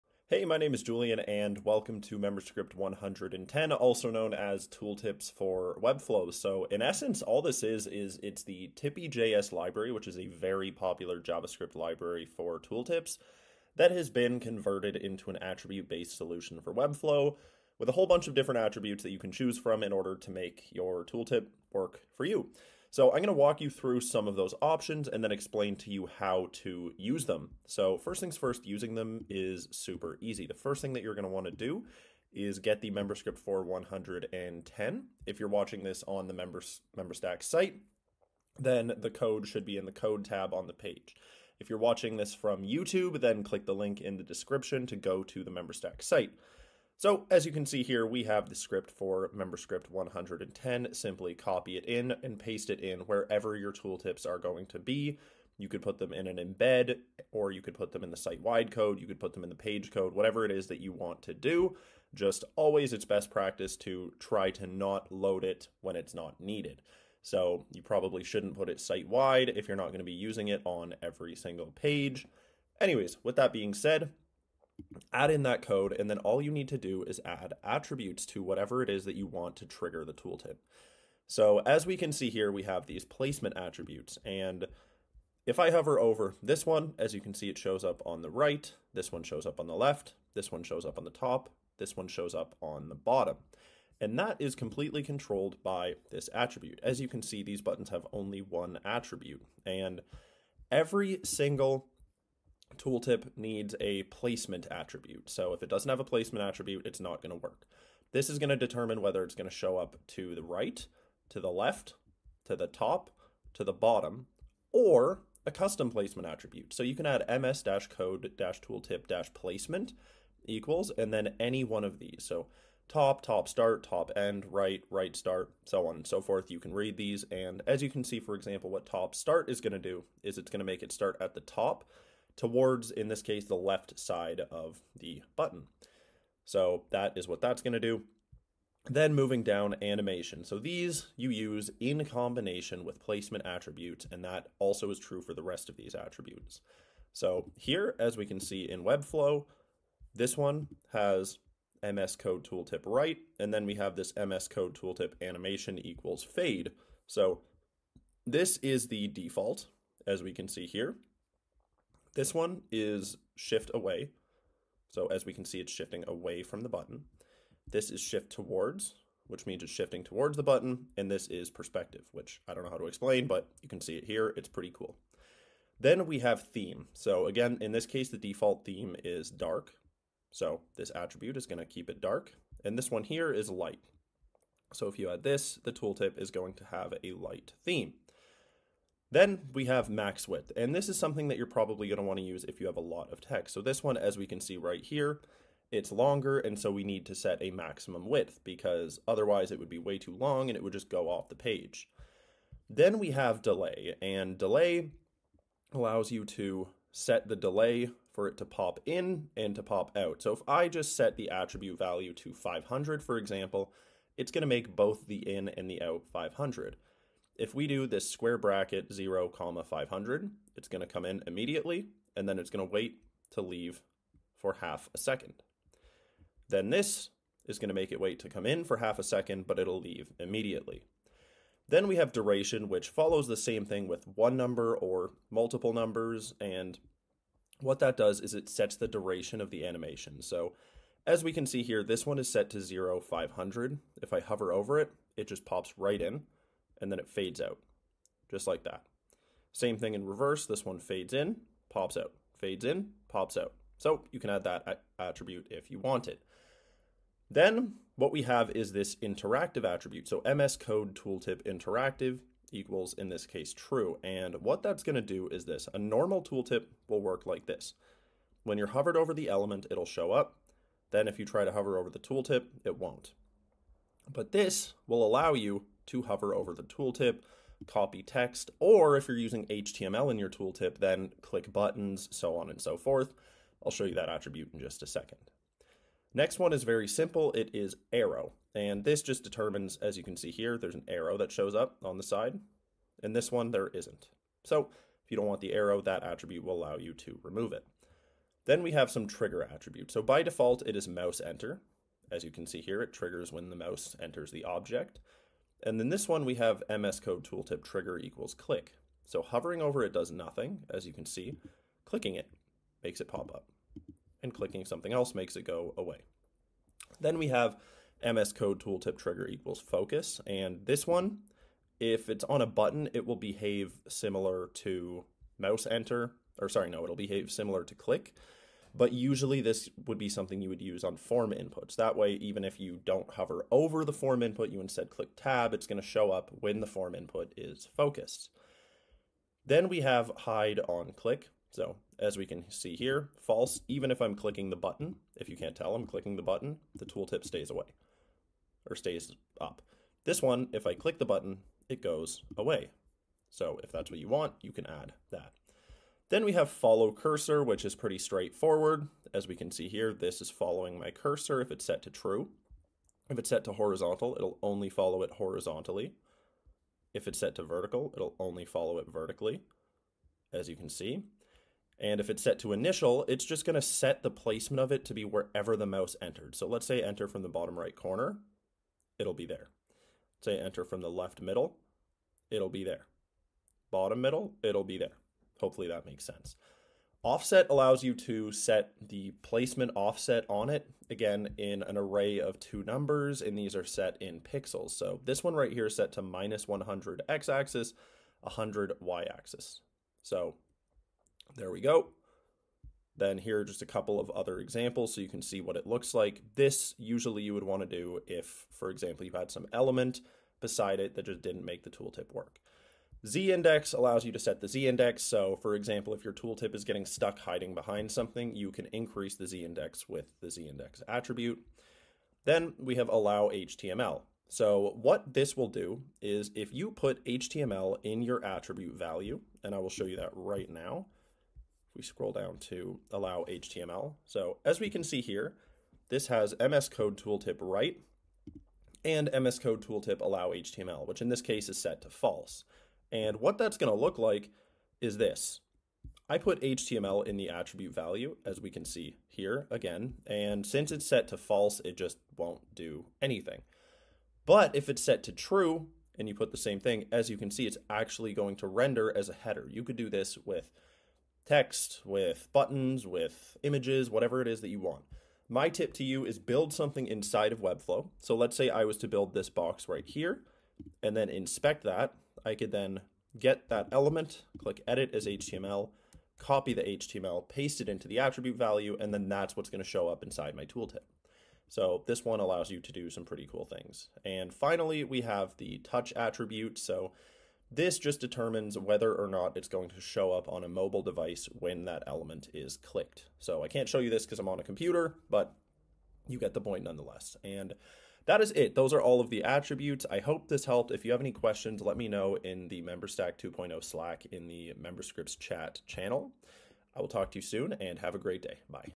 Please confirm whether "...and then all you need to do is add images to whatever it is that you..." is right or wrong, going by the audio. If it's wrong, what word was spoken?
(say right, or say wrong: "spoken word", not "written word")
wrong: "attributes", not "images".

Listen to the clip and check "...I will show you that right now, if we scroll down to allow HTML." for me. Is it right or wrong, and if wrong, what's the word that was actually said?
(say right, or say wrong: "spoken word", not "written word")
right.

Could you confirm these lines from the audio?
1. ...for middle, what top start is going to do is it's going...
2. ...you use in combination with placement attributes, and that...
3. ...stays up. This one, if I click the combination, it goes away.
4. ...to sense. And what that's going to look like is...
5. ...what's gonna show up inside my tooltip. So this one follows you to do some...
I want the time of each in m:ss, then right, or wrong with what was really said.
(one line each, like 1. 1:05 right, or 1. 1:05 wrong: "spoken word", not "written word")
1. 2:08 wrong: "example", not "middle"
2. 2:21 right
3. 5:48 wrong: "button", not "combination"
4. 7:21 wrong: "false", not "sense"
5. 7:59 wrong: "allows", not "follows".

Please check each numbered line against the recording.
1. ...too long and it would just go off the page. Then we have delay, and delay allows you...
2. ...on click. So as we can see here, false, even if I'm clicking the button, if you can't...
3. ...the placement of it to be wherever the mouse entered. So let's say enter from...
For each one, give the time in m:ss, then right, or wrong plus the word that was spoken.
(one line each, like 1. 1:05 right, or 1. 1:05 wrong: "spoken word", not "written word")
1. 3:19 right
2. 5:40 right
3. 6:14 right.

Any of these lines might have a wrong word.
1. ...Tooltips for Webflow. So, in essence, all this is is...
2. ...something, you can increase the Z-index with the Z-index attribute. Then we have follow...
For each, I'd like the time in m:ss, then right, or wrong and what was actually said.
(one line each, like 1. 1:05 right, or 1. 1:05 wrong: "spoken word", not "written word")
1. 0:04 right
2. 6:57 wrong: "allow", not "follow".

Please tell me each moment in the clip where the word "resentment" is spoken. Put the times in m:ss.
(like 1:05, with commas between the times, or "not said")
not said.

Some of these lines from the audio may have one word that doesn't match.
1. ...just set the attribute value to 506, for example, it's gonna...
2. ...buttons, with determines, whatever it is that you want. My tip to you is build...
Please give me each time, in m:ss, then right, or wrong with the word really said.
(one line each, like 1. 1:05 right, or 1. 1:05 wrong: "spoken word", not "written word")
1. 3:30 wrong: "500", not "506"
2. 7:42 wrong: "images", not "determines".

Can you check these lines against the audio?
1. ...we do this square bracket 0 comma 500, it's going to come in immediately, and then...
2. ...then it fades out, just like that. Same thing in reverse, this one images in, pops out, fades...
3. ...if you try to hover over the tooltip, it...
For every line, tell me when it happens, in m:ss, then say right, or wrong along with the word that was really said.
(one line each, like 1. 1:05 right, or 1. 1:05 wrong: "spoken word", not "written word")
1. 3:37 right
2. 4:06 wrong: "fades", not "images"
3. 4:31 right.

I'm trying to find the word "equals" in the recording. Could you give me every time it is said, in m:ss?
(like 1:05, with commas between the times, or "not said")
2:00, 2:35, 4:22, 5:07, 5:19.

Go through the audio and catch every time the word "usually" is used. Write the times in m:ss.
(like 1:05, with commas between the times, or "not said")
5:28, 6:46.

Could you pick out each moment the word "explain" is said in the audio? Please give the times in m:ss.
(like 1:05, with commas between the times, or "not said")
0:25, 2:52.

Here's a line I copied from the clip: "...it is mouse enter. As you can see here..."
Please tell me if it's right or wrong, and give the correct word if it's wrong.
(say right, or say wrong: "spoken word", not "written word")
right.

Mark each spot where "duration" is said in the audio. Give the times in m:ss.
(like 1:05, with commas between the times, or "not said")
3:52, 3:58.